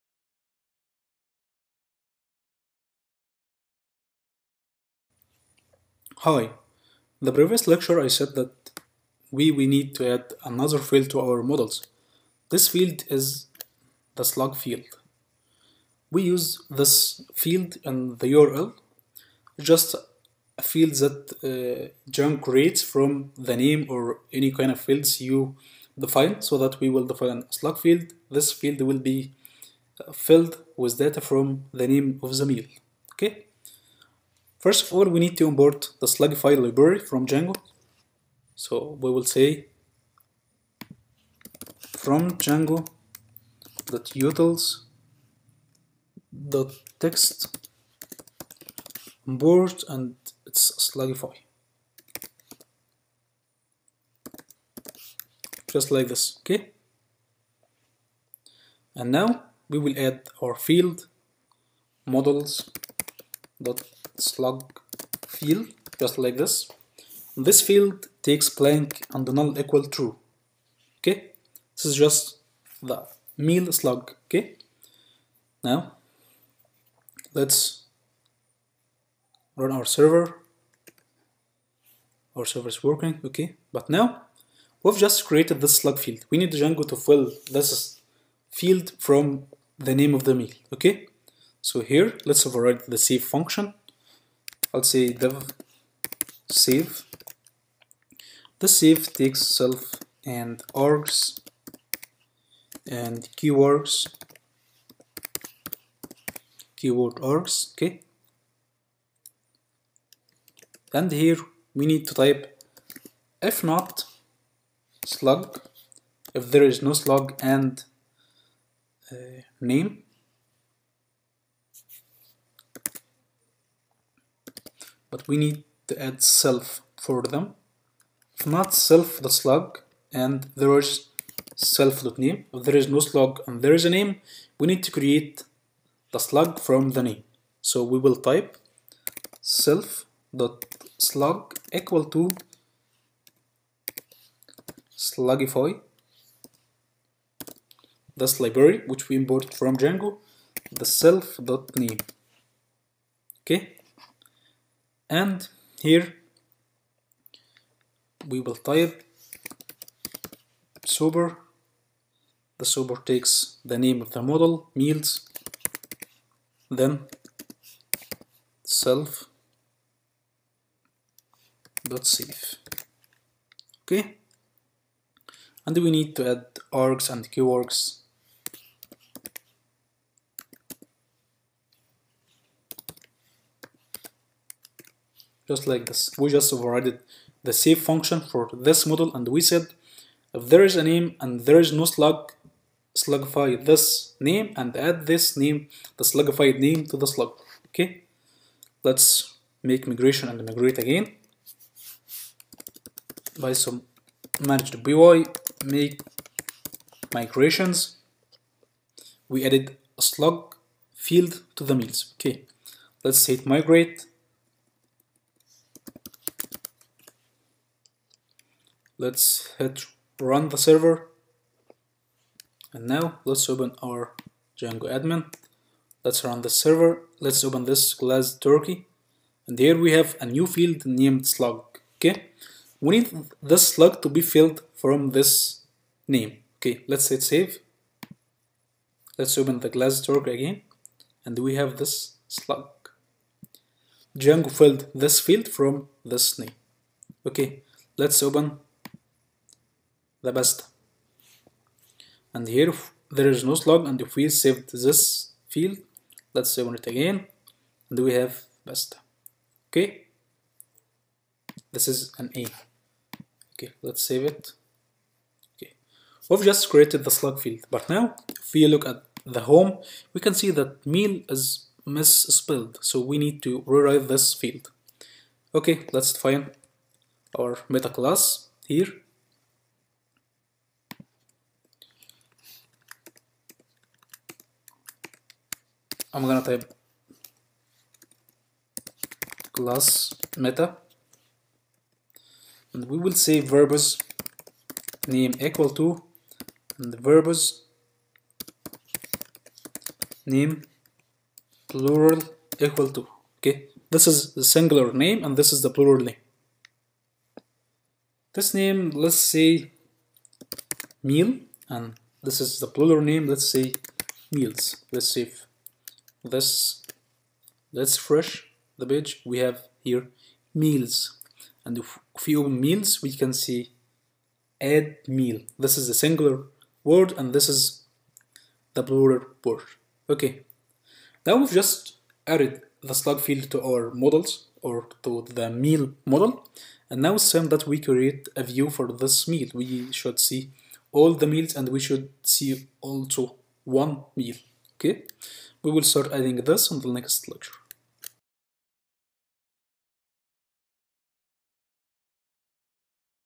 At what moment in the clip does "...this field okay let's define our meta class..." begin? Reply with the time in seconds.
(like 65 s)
274 s.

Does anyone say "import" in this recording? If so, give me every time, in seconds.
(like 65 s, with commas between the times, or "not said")
35 s, 49 s, 149 s.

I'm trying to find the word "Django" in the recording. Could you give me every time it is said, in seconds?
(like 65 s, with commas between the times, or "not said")
22 s, 37 s, 42 s, 86 s, 149 s, 224 s, 244 s.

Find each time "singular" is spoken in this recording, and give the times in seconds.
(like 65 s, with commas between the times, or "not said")
304 s, 325 s.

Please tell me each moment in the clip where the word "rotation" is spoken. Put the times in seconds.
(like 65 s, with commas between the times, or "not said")
not said.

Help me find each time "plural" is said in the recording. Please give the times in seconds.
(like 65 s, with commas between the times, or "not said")
301 s, 305 s, 312 s, 328 s.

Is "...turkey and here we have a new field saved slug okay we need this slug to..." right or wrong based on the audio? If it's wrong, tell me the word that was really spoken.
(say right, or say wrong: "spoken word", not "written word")
wrong: "named", not "saved".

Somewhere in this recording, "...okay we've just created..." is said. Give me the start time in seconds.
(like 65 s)
265 s.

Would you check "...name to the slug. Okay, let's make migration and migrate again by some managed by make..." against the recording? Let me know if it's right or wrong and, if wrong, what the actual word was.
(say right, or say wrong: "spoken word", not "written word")
right.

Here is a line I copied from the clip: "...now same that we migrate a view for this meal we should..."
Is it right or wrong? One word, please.
wrong.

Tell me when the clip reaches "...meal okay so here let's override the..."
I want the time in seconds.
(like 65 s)
90 s.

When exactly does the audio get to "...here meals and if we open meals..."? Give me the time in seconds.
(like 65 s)
319 s.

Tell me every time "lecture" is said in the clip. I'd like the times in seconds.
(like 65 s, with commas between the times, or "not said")
7 s, 347 s.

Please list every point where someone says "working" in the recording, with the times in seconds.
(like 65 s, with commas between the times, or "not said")
82 s.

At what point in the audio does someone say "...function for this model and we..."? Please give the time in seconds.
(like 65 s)
187 s.